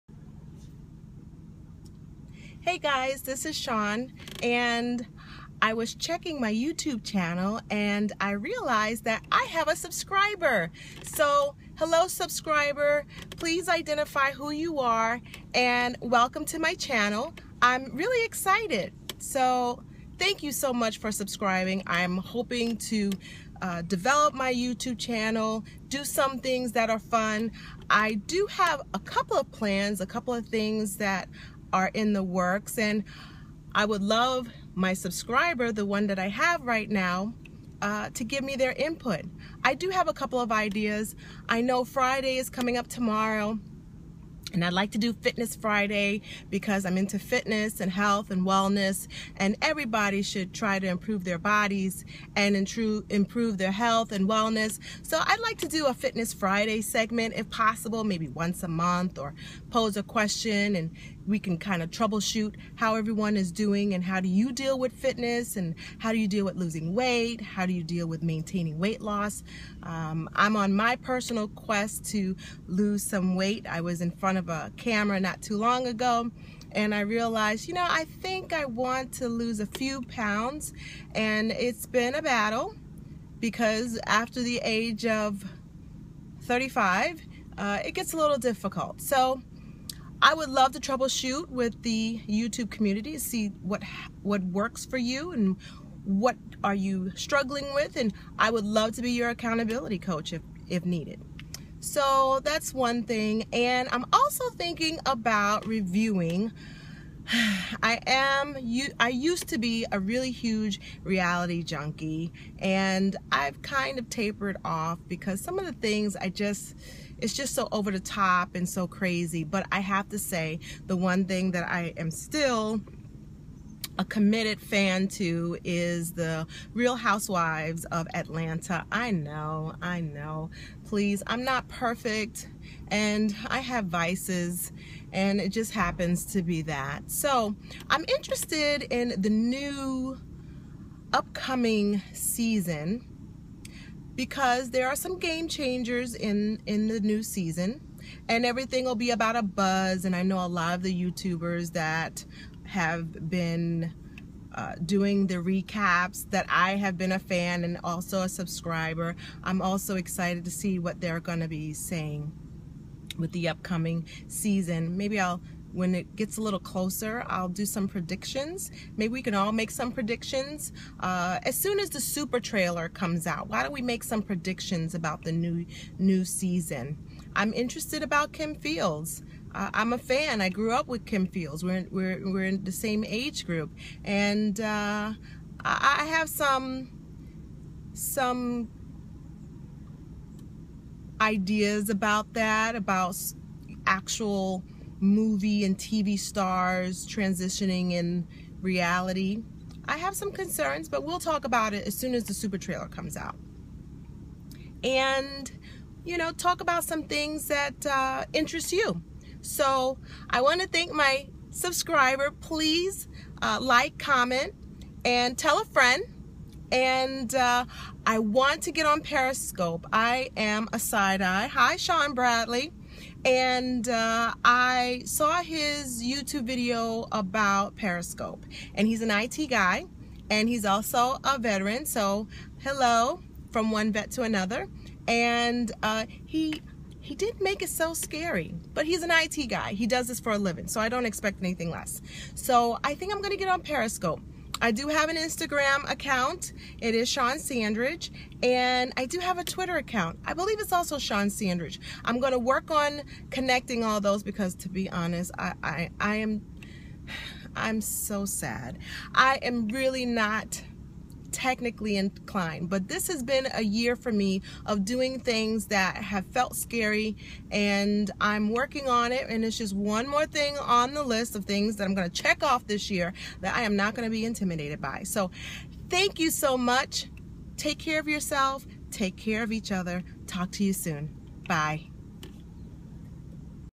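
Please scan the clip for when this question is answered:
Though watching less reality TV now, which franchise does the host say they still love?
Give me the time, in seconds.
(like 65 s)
126 s.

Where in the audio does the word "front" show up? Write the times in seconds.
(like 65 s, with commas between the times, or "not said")
74 s.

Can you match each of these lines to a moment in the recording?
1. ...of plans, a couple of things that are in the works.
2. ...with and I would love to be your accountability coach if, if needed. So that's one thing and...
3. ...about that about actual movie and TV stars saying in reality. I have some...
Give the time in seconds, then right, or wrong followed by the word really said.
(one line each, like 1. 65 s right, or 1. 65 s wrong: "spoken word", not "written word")
1. 29 s right
2. 97 s right
3. 191 s wrong: "transitioning", not "saying".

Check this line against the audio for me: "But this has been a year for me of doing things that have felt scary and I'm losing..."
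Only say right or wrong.
wrong.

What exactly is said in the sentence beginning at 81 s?
And it's been a battle because after the age of 35, uh, it gets a little difficult.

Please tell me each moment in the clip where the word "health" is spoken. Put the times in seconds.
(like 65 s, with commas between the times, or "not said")
47 s, 53 s.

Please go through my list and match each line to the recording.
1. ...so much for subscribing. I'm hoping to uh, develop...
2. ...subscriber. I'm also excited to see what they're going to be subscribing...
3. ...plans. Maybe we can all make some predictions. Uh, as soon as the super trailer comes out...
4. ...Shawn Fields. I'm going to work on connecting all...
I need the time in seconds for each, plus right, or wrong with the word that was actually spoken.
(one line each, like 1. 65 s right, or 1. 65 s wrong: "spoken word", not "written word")
1. 20 s right
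2. 158 s wrong: "saying", not "subscribing"
3. 167 s wrong: "predictions", not "plans"
4. 250 s wrong: "Sandridge", not "Fields".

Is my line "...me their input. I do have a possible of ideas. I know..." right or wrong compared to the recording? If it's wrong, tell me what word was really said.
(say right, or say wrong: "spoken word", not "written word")
wrong: "couple", not "possible".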